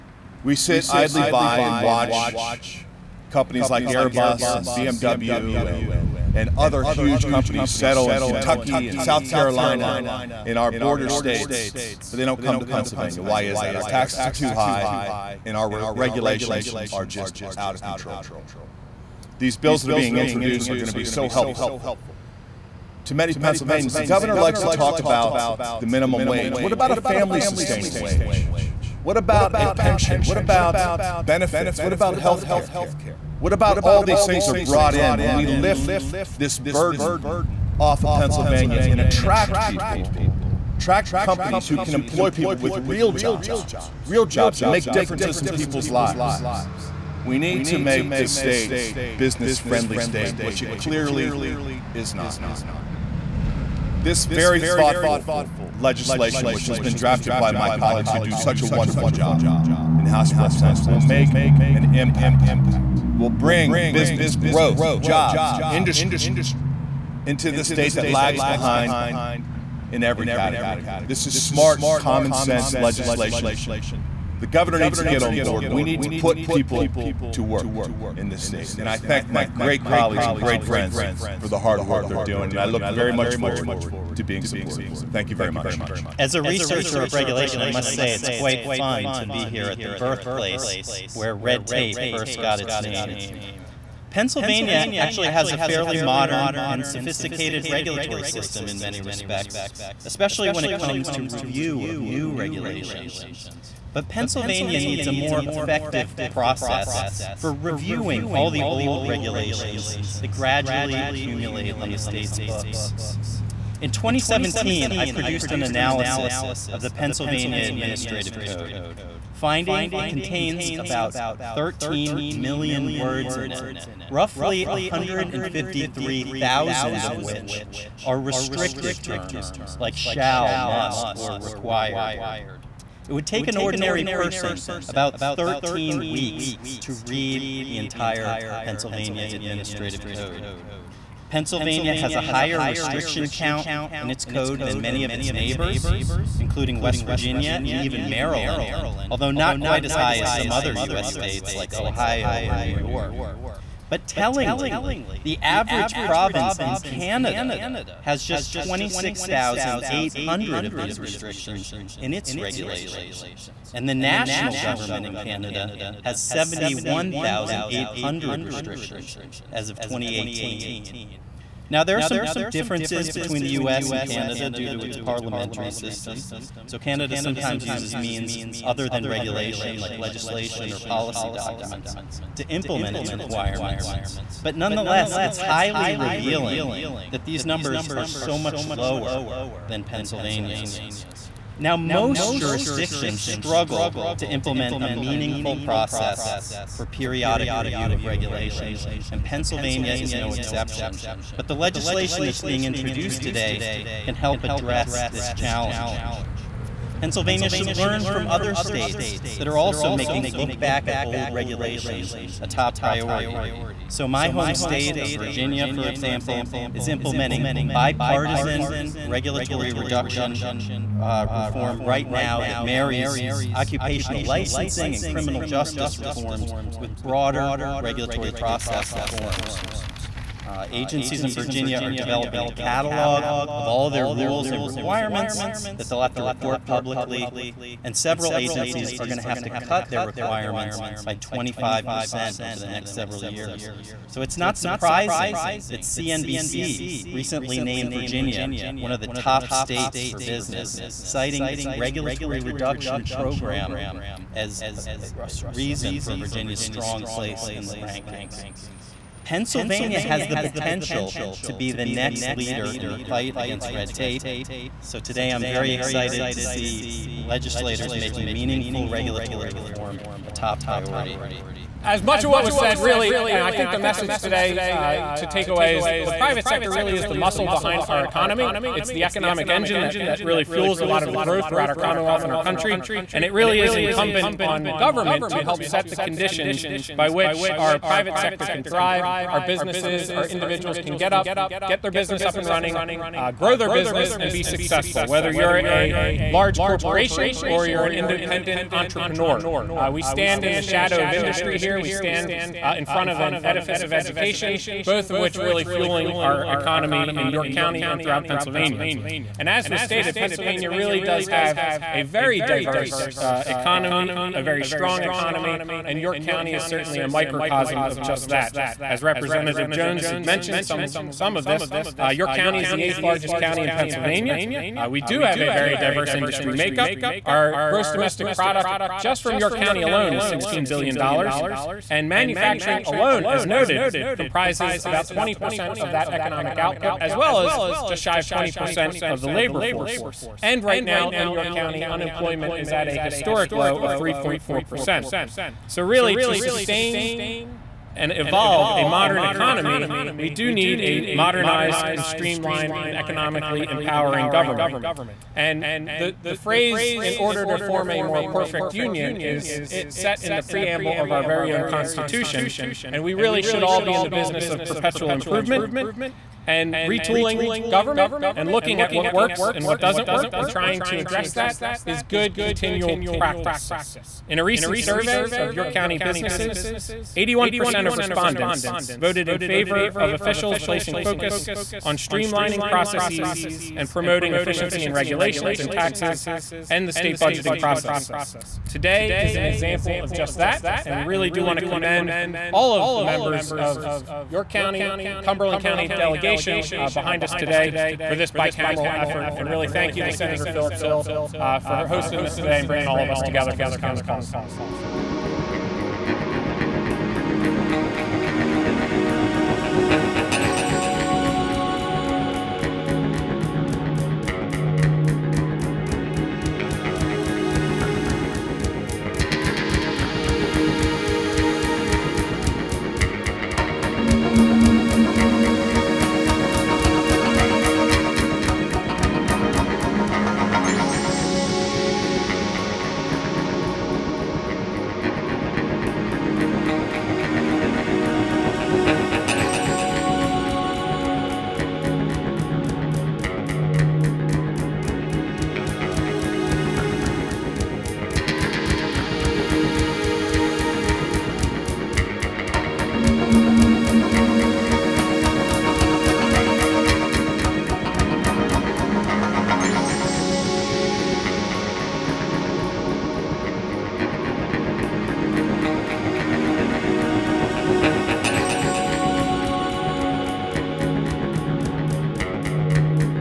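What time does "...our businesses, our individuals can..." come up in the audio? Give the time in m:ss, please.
4:49.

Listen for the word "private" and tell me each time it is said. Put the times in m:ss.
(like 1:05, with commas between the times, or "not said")
4:36, 4:47.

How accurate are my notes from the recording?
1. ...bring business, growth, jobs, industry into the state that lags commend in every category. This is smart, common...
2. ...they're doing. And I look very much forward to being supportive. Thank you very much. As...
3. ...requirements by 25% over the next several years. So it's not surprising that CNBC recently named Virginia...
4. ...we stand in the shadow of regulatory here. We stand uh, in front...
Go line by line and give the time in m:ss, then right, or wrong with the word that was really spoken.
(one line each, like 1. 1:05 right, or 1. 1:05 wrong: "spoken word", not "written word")
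1. 1:03 wrong: "behind", not "commend"
2. 1:22 right
3. 4:00 right
4. 4:59 wrong: "industry", not "regulatory".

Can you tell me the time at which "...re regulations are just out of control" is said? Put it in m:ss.
0:15.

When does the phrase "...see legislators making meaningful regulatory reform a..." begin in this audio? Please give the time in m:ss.
4:26.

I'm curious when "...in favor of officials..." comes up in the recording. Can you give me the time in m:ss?
6:19.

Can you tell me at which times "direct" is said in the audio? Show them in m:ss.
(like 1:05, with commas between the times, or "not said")
not said.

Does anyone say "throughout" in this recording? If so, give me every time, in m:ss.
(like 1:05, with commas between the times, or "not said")
4:41, 5:08.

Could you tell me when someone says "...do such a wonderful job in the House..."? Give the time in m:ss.
0:58.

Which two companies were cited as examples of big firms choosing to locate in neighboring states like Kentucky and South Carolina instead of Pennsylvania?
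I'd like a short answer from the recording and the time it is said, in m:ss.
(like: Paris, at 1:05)
Airbus and BMW, at 0:03.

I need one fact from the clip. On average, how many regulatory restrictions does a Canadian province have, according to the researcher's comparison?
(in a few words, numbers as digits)
26,800.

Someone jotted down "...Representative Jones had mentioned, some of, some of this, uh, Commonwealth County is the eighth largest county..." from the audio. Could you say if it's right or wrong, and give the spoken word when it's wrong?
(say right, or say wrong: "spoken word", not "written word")
wrong: "York", not "Commonwealth".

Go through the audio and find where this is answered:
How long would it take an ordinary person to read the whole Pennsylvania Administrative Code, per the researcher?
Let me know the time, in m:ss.
2:15.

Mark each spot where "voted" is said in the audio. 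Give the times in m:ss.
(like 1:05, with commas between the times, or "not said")
6:18.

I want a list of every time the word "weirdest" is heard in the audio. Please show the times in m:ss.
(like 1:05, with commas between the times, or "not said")
not said.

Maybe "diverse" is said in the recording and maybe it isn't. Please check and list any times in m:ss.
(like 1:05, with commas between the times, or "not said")
5:12, 5:25.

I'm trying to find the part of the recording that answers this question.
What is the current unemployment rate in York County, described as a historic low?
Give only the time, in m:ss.
5:43.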